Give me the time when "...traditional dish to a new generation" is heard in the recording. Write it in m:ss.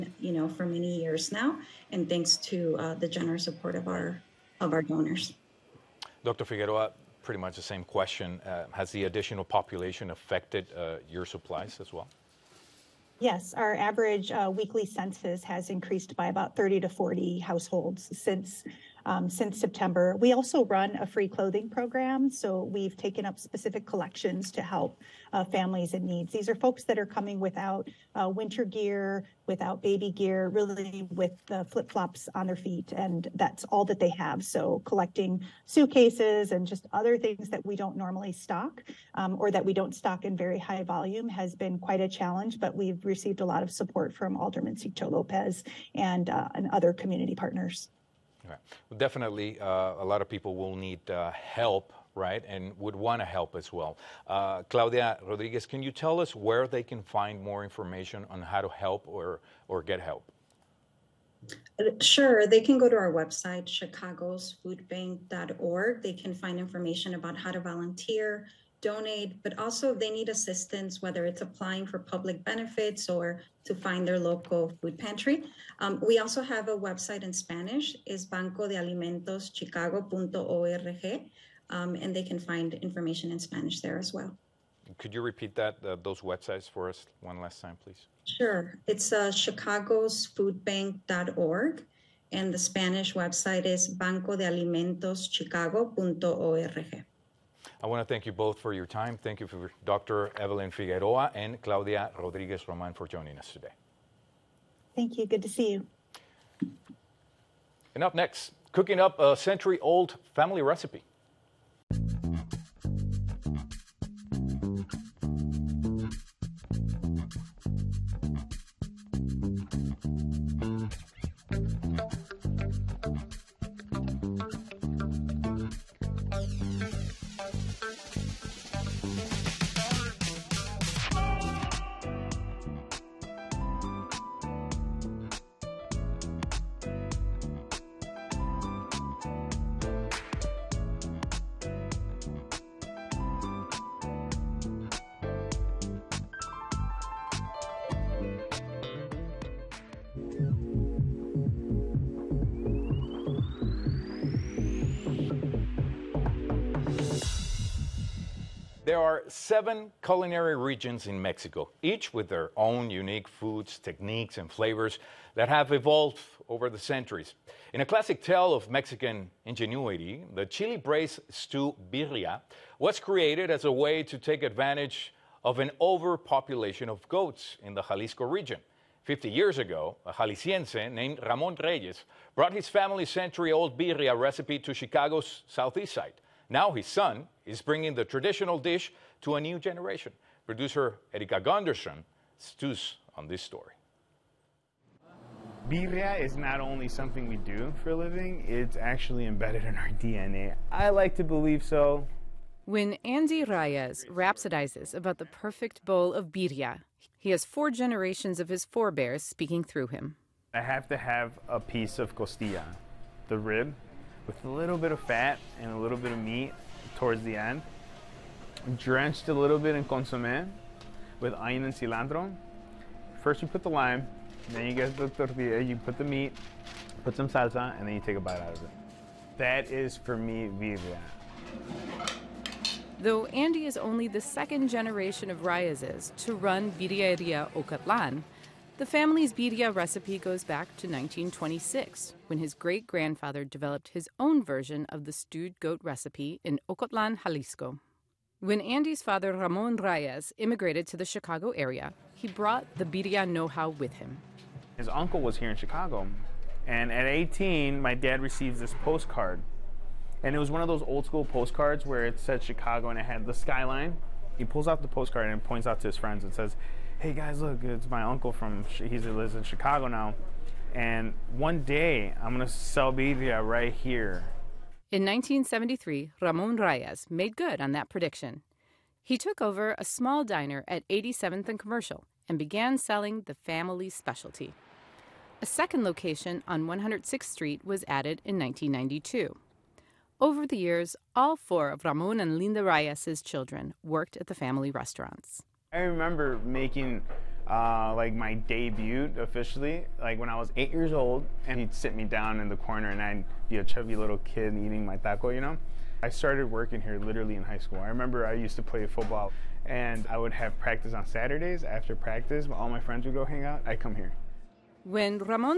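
3:08.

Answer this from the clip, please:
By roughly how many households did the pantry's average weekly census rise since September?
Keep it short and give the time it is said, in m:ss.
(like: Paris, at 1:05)
30 to 40, at 0:16.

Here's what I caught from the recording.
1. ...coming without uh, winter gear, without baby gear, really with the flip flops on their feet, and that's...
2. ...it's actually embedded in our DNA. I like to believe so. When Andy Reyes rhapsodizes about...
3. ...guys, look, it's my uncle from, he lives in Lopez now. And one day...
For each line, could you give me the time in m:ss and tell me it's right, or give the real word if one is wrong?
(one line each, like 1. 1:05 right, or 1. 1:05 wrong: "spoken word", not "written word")
1. 0:27 right
2. 3:18 right
3. 4:27 wrong: "Chicago", not "Lopez".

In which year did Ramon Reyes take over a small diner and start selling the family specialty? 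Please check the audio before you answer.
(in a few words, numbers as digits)
1973.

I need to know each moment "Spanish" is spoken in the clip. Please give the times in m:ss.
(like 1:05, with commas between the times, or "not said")
1:17, 1:23, 1:32.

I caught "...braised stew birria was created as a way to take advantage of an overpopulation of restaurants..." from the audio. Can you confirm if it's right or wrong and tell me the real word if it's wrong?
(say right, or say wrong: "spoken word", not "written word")
wrong: "goats", not "restaurants".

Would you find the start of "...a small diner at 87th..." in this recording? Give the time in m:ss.
4:39.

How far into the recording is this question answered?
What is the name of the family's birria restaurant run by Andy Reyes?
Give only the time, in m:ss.
3:56.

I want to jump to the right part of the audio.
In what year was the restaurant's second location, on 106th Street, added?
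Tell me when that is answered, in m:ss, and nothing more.
4:48.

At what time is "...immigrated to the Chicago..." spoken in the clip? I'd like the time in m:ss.
4:10.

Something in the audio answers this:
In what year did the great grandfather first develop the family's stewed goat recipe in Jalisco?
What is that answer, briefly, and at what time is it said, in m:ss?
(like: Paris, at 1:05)
1926, at 4:00.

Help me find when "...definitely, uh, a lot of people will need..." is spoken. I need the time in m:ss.
0:48.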